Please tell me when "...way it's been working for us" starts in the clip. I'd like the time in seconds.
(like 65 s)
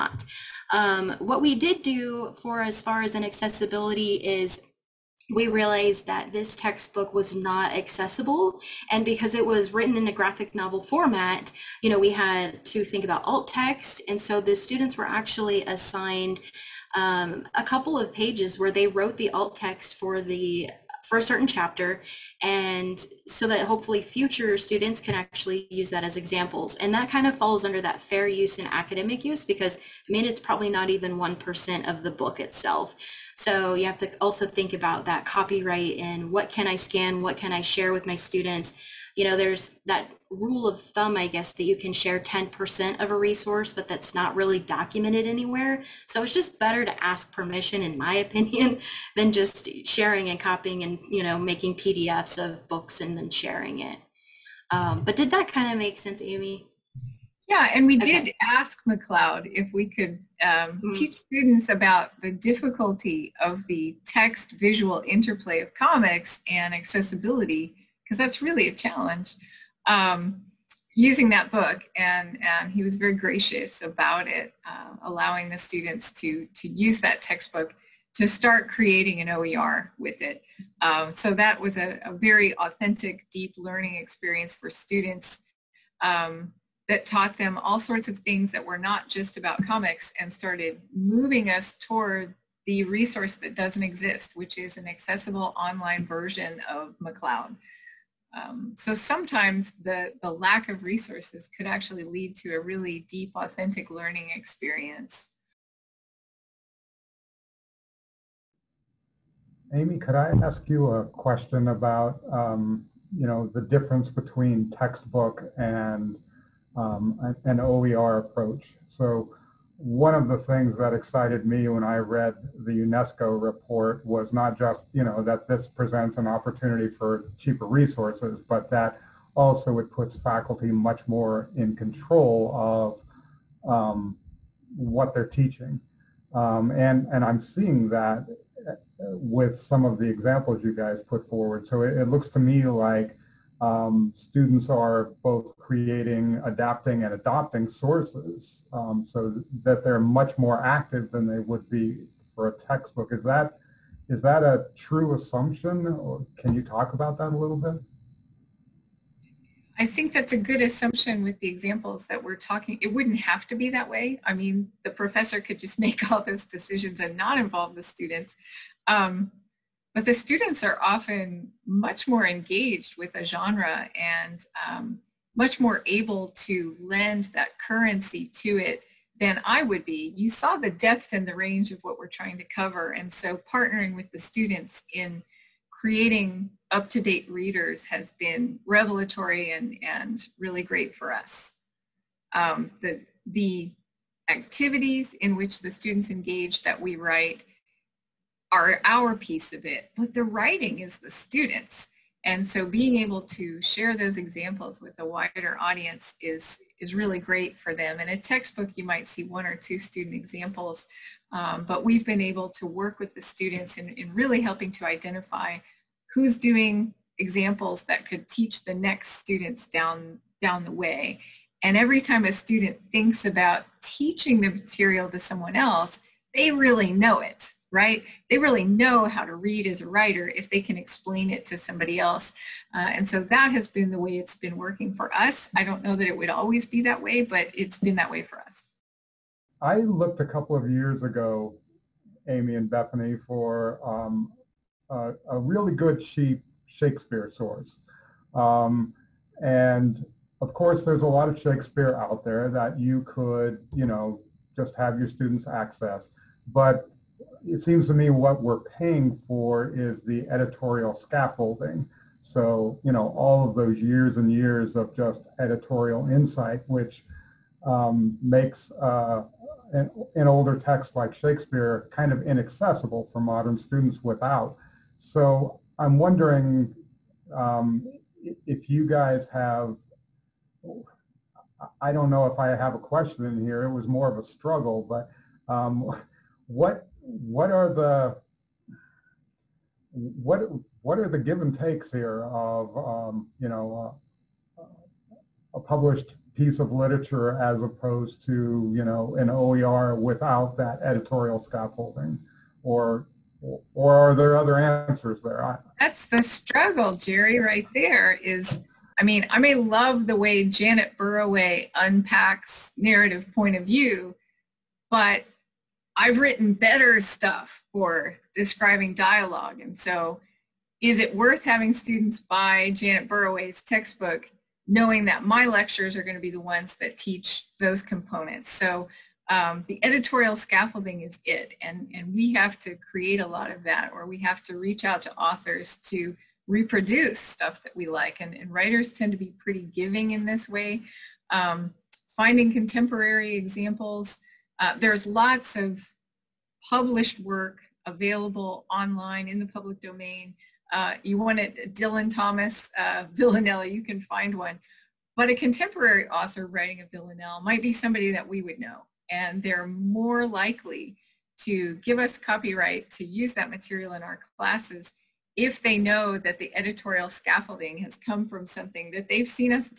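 233 s.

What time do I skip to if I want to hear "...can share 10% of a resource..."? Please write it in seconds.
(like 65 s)
41 s.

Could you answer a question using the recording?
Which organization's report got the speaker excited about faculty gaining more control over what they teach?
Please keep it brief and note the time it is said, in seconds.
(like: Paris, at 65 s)
UNESCO, at 122 s.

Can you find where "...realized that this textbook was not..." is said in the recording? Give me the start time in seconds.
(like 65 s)
5 s.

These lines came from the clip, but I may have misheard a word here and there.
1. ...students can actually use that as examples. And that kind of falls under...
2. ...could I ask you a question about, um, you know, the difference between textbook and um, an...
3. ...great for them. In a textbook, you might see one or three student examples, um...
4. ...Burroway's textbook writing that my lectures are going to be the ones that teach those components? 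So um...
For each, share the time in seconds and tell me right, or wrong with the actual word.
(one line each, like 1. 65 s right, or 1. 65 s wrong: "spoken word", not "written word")
1. 24 s right
2. 109 s right
3. 207 s wrong: "two", not "three"
4. 323 s wrong: "knowing", not "writing".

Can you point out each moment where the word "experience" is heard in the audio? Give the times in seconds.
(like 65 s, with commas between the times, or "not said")
83 s, 104 s.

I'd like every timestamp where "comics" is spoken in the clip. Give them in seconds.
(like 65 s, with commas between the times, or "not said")
65 s, 89 s.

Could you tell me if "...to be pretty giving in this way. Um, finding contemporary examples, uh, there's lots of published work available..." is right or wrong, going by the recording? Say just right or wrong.
right.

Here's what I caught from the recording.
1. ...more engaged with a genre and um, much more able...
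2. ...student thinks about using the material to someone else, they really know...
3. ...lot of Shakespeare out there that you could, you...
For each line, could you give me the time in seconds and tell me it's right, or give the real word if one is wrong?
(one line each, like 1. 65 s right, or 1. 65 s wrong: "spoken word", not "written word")
1. 172 s right
2. 222 s wrong: "teaching", not "using"
3. 251 s right.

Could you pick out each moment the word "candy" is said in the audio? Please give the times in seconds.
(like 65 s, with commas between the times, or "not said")
not said.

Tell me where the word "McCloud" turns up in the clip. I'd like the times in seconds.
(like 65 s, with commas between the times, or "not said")
58 s, 97 s.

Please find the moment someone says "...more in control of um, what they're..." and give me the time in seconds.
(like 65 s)
131 s.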